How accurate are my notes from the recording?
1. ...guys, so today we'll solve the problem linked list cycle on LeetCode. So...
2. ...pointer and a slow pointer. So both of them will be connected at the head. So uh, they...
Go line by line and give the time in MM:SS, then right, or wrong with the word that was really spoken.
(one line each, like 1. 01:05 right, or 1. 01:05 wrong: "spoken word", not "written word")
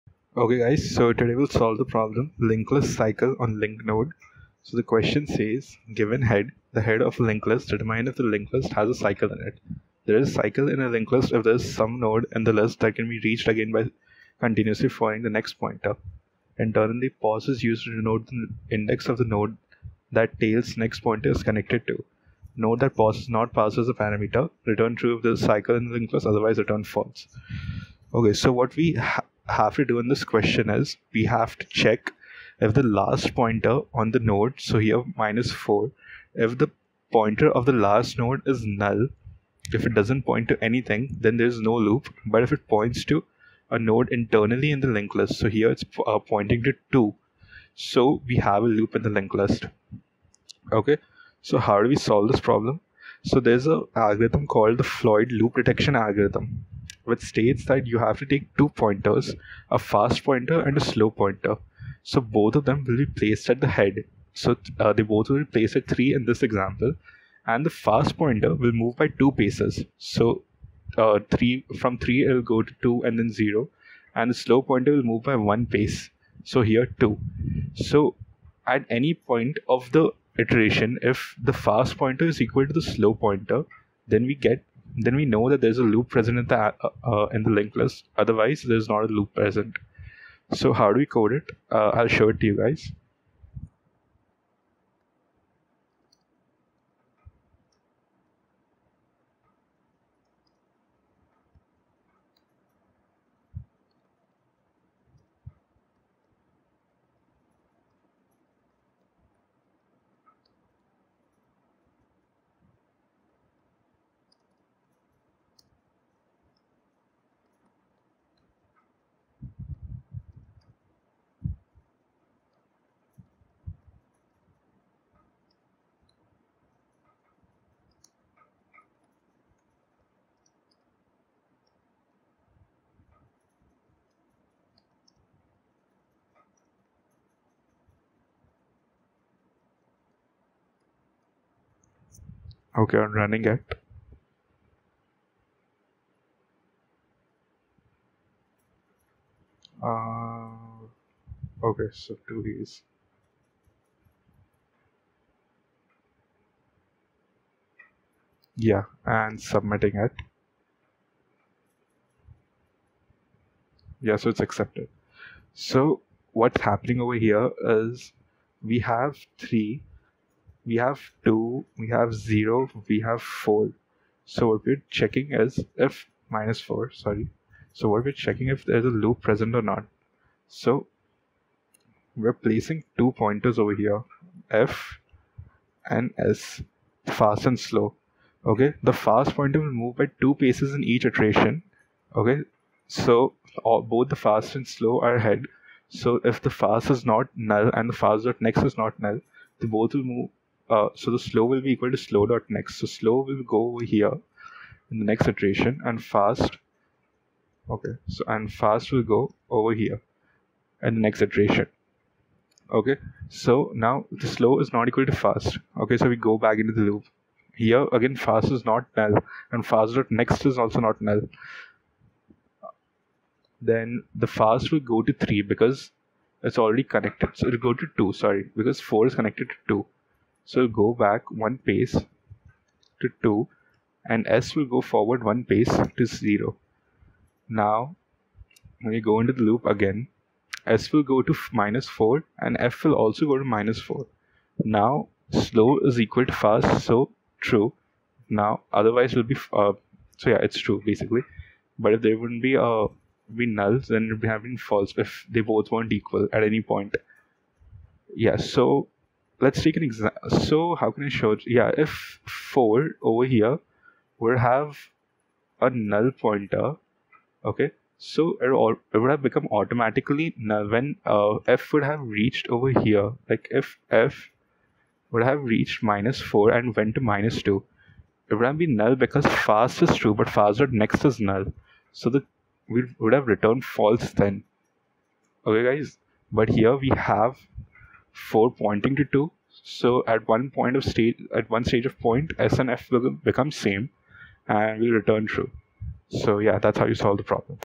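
1. 00:00 right
2. 01:00 wrong: "placed", not "connected".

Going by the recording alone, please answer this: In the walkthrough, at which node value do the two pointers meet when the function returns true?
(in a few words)
-4.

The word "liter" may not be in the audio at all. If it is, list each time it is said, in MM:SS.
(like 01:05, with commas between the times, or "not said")
not said.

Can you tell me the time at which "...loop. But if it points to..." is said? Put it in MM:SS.
00:41.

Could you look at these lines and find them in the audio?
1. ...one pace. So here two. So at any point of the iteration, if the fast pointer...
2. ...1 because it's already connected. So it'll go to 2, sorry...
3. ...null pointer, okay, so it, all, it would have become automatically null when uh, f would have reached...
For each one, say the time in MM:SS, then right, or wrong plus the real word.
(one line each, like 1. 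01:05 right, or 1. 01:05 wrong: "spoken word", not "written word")
1. 01:15 right
2. 03:45 wrong: "3", not "1"
3. 04:25 right.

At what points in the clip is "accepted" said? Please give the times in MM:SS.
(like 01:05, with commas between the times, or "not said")
02:44.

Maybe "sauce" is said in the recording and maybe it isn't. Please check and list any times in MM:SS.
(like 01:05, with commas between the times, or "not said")
not said.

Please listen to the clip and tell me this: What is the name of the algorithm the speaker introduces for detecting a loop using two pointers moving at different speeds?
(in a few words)
Floyd loop detection algorithm.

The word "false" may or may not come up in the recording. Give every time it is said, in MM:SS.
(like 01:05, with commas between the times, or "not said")
00:26, 04:14, 04:43.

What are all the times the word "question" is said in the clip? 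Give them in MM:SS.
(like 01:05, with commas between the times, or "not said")
00:04, 00:30.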